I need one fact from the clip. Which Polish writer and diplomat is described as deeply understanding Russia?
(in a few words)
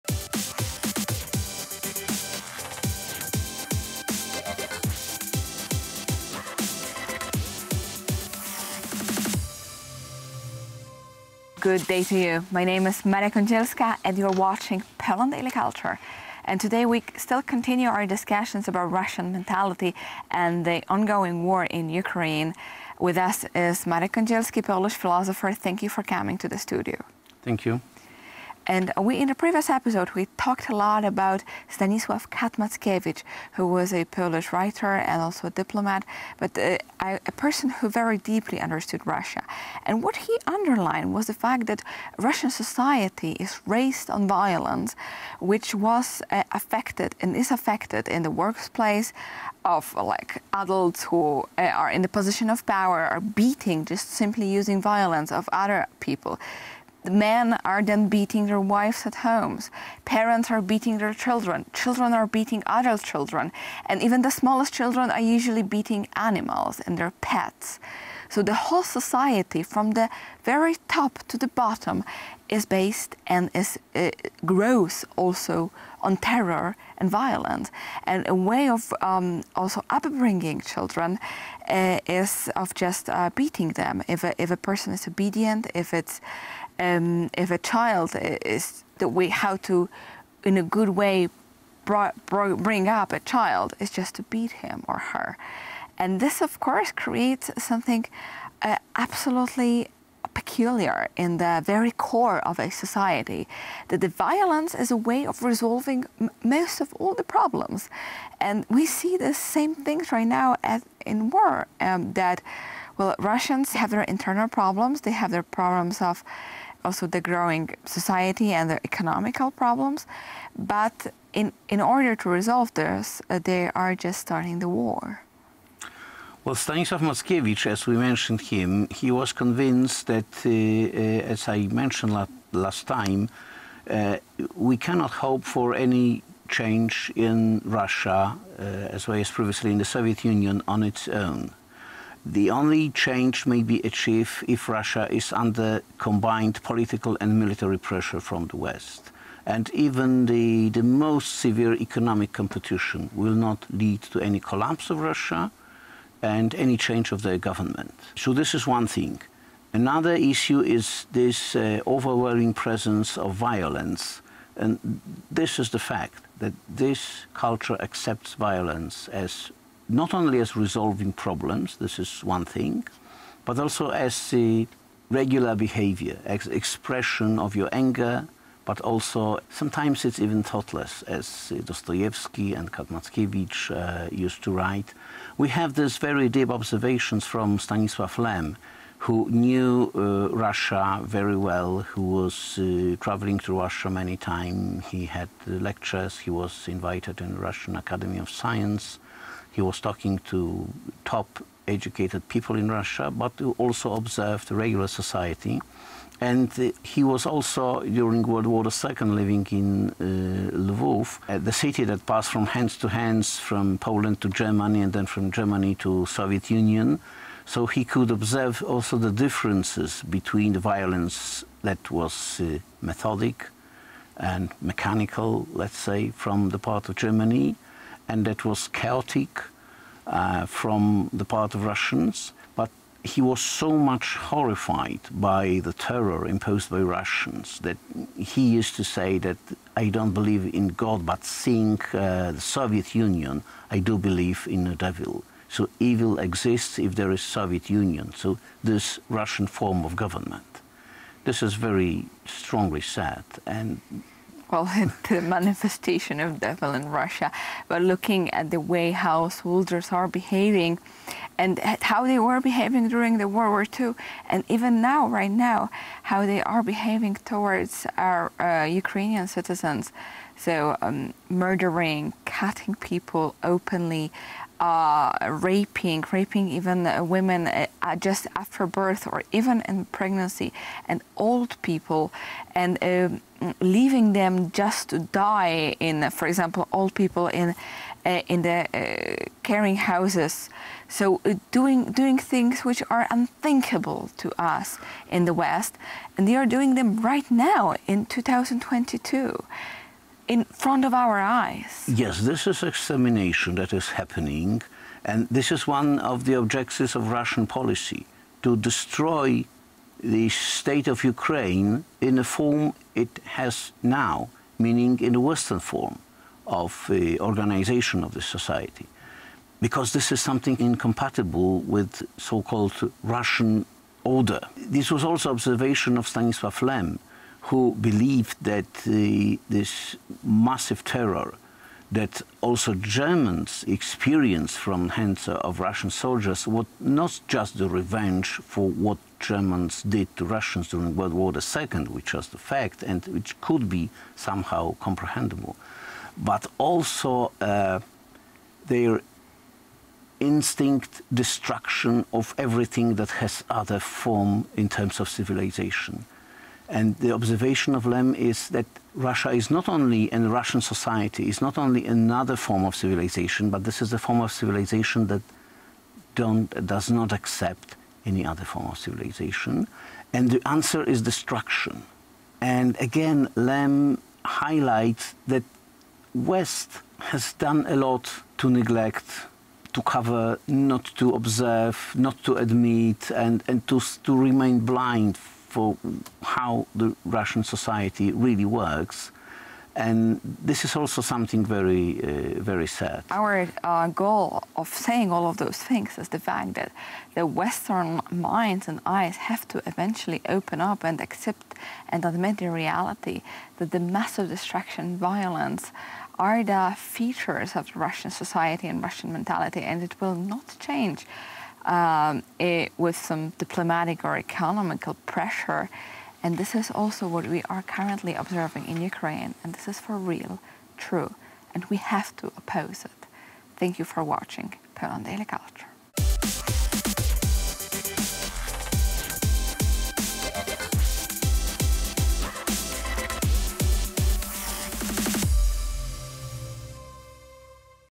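Stanisław Cat-Mackiewicz.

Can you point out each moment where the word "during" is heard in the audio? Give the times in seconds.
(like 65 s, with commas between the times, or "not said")
207 s, 262 s, 340 s.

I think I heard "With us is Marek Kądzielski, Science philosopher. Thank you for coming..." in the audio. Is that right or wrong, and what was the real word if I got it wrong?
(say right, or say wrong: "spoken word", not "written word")
wrong: "Polish", not "Science".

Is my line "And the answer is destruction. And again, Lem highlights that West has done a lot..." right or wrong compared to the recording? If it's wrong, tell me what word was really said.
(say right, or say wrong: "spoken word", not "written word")
right.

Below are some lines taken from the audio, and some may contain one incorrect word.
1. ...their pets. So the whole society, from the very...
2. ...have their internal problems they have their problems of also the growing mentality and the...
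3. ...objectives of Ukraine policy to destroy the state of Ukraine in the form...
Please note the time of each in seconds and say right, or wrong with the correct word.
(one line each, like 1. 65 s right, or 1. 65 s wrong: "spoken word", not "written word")
1. 66 s right
2. 113 s wrong: "society", not "mentality"
3. 306 s wrong: "Russian", not "Ukraine".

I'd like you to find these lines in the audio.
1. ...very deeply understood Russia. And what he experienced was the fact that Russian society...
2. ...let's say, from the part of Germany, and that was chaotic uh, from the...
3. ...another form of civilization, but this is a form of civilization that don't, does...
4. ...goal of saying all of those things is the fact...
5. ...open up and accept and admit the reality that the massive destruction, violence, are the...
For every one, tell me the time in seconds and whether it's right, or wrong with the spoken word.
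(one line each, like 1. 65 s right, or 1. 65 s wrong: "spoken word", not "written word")
1. 37 s wrong: "underlined", not "experienced"
2. 225 s right
3. 361 s right
4. 393 s right
5. 400 s right.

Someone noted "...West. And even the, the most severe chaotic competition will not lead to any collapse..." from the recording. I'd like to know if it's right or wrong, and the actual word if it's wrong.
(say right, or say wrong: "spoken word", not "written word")
wrong: "economic", not "chaotic".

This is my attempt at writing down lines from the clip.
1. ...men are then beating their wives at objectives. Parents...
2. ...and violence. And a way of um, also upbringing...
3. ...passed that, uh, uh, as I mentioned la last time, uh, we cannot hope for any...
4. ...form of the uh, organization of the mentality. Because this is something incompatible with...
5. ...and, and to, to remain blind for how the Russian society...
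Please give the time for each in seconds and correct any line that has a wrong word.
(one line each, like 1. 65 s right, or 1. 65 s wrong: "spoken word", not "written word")
1. 57 s wrong: "homes", not "objectives"
2. 76 s right
3. 129 s wrong: "convinced", not "passed"
4. 315 s wrong: "society", not "mentality"
5. 383 s right.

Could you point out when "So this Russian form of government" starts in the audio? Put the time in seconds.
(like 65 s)
248 s.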